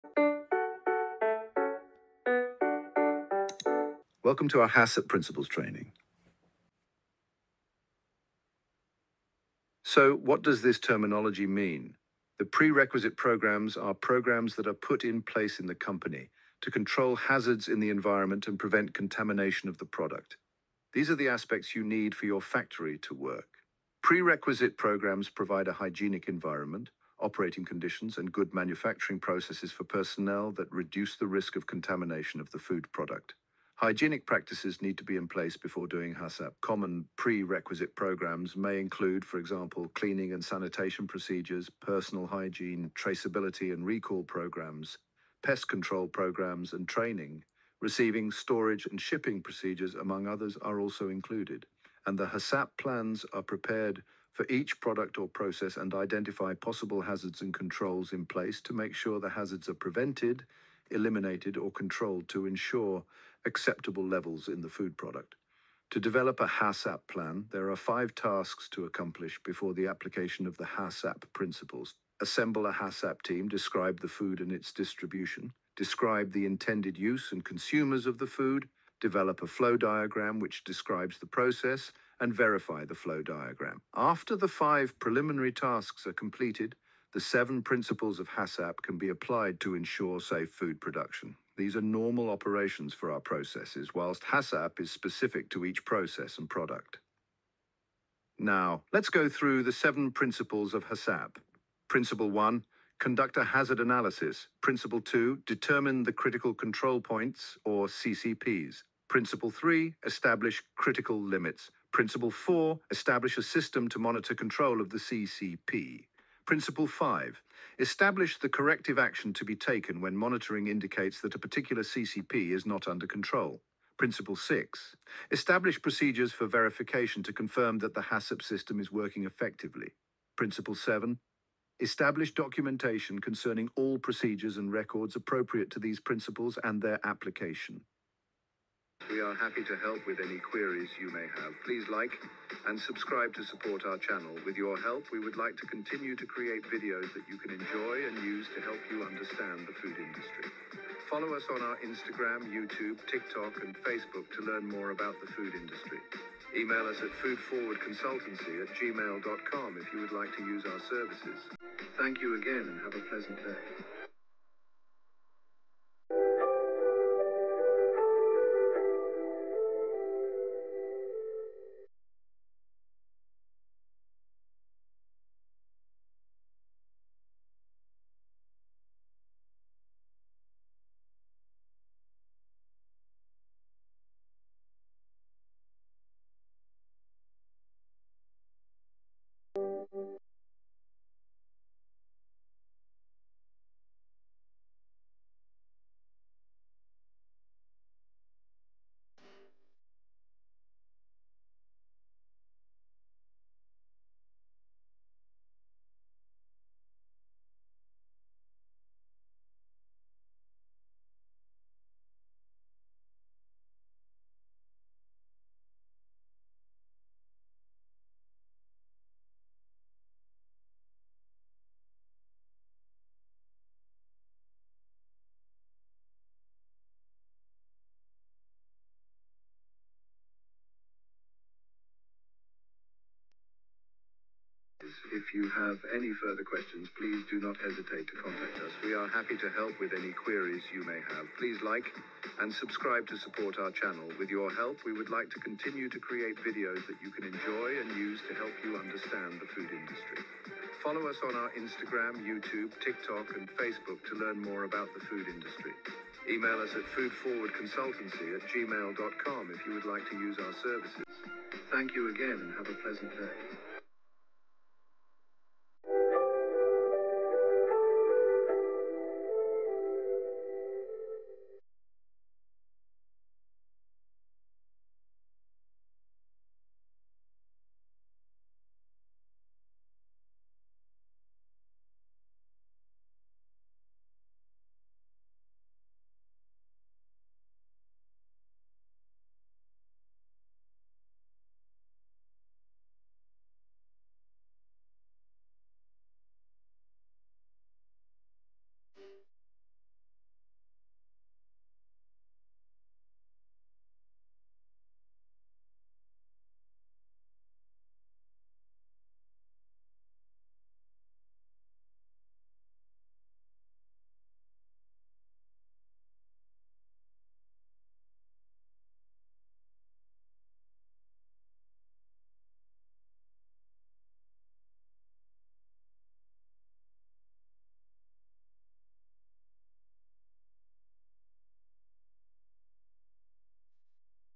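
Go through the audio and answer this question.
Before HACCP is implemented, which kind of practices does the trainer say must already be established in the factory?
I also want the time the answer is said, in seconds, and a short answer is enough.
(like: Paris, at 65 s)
Hygienic practices, at 33 s.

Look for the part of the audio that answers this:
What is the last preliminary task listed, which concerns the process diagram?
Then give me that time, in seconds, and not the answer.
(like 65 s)
82 s.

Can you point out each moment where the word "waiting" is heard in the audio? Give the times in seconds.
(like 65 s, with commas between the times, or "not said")
not said.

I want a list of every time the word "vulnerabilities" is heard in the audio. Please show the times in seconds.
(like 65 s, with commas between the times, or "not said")
not said.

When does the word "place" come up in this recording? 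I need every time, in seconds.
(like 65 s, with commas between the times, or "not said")
15 s, 35 s, 58 s.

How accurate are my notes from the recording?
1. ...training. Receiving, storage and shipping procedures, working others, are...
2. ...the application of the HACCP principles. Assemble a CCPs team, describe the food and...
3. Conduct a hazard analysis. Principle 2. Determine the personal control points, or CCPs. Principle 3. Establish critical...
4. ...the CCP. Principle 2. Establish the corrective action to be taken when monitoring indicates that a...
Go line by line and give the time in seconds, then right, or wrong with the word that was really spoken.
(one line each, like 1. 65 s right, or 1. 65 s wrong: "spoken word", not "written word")
1. 46 s wrong: "among", not "working"
2. 69 s wrong: "HACCP", not "CCPs"
3. 102 s wrong: "critical", not "personal"
4. 114 s wrong: "5", not "2".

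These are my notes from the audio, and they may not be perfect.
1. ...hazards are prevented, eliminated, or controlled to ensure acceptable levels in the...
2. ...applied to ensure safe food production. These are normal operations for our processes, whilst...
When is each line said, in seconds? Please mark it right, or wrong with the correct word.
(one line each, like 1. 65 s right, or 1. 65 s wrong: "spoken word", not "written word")
1. 59 s right
2. 89 s right.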